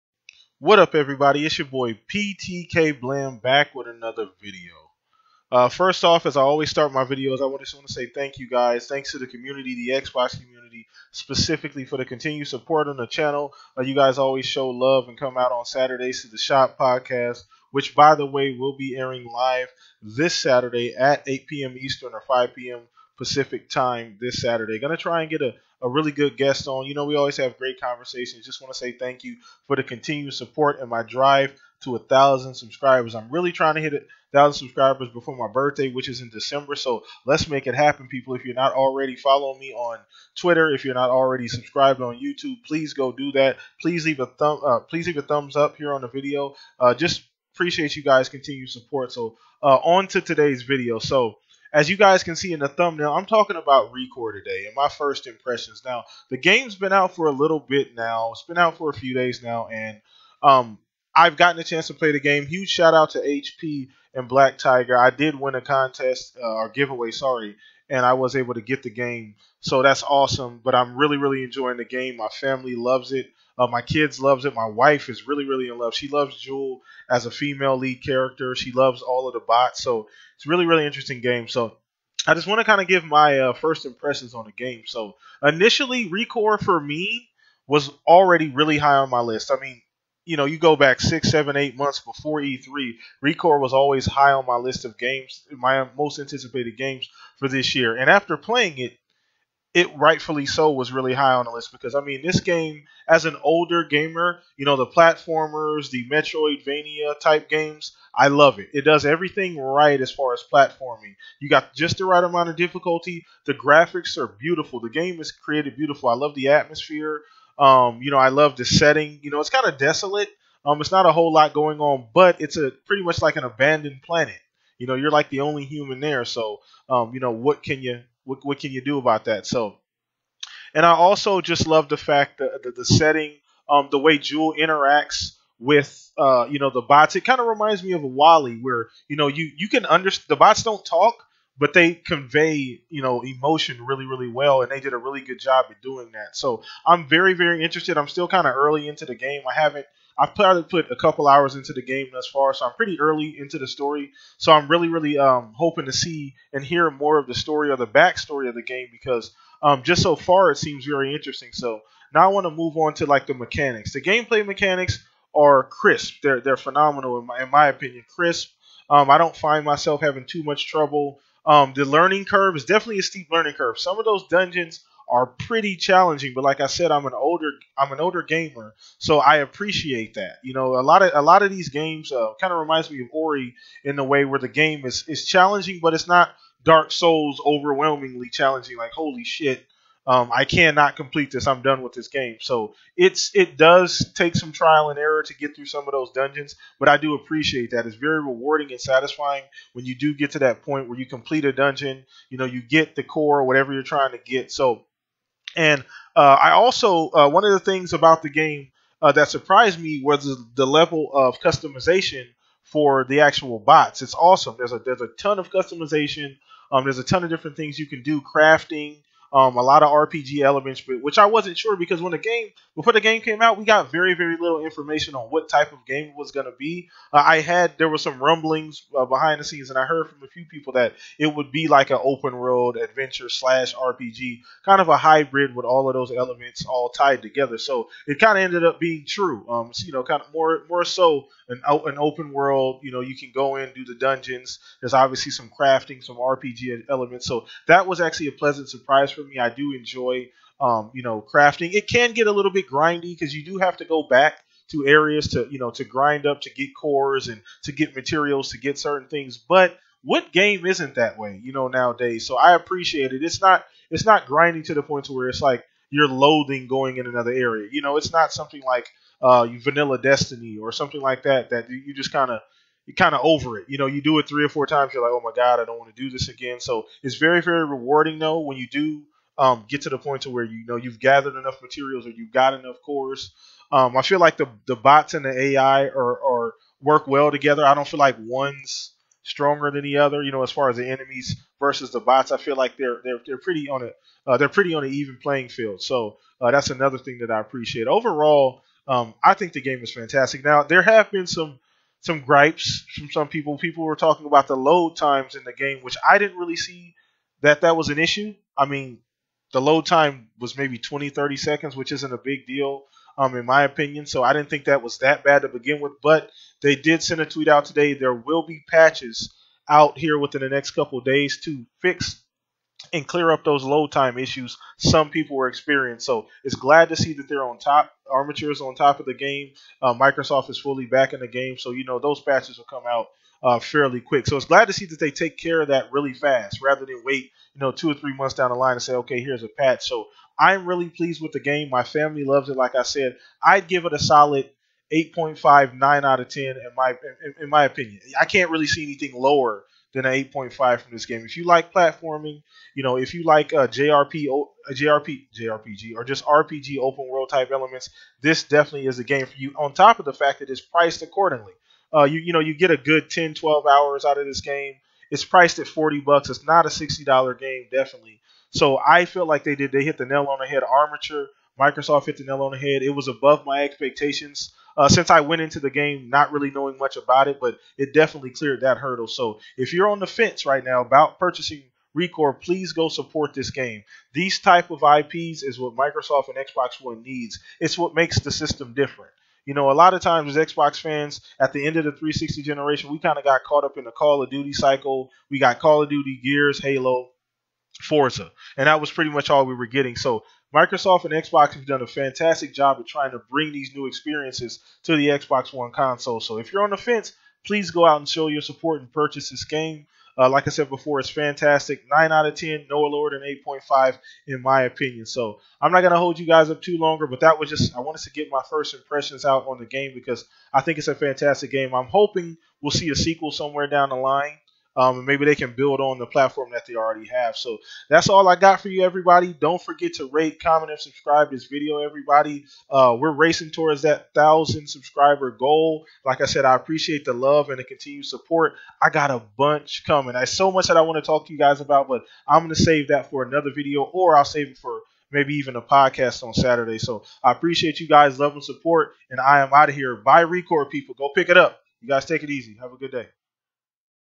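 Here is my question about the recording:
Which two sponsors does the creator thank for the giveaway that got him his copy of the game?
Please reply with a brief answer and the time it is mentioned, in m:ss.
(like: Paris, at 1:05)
HP and Black Tiger, at 1:03.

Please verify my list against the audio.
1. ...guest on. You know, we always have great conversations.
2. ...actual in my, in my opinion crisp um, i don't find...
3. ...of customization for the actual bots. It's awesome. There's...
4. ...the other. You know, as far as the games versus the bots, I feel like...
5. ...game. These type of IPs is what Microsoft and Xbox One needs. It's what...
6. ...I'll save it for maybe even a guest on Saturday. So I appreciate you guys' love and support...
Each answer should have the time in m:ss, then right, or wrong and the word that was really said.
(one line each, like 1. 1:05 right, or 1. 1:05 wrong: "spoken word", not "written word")
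1. 0:26 right
2. 2:46 wrong: "phenomenal", not "actual"
3. 3:31 right
4. 4:49 wrong: "enemies", not "games"
5. 6:23 right
6. 7:24 wrong: "podcast", not "guest".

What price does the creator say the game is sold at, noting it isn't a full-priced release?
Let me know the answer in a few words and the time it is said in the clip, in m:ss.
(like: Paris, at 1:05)
$40, at 6:05.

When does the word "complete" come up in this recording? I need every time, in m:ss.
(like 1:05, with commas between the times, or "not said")
3:10, 3:21.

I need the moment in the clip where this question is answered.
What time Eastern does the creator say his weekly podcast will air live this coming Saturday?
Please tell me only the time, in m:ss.
0:21.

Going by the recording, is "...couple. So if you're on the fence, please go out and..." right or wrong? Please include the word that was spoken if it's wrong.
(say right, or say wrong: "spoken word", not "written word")
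wrong: "console", not "couple".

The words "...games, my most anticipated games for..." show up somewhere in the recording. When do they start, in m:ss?
1:34.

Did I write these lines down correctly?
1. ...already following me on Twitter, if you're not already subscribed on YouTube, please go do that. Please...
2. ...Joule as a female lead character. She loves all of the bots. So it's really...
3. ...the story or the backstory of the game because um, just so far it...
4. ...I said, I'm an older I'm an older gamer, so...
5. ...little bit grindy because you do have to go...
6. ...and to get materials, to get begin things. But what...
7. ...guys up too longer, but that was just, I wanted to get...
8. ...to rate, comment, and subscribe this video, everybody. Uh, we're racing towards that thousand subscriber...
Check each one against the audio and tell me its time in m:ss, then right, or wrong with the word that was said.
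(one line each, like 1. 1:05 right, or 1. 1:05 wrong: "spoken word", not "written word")
1. 0:38 right
2. 1:16 right
3. 2:37 right
4. 2:56 right
5. 4:12 right
6. 4:17 wrong: "certain", not "begin"
7. 6:56 right
8. 7:09 right.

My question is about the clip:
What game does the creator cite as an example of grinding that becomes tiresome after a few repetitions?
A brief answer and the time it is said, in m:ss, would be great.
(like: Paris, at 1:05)
Vanilla Destiny, at 4:29.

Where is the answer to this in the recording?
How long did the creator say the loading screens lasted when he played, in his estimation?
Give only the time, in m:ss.
5:10.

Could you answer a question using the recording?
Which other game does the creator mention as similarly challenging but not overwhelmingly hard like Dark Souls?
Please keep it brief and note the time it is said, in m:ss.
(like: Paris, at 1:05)
Ori, at 3:03.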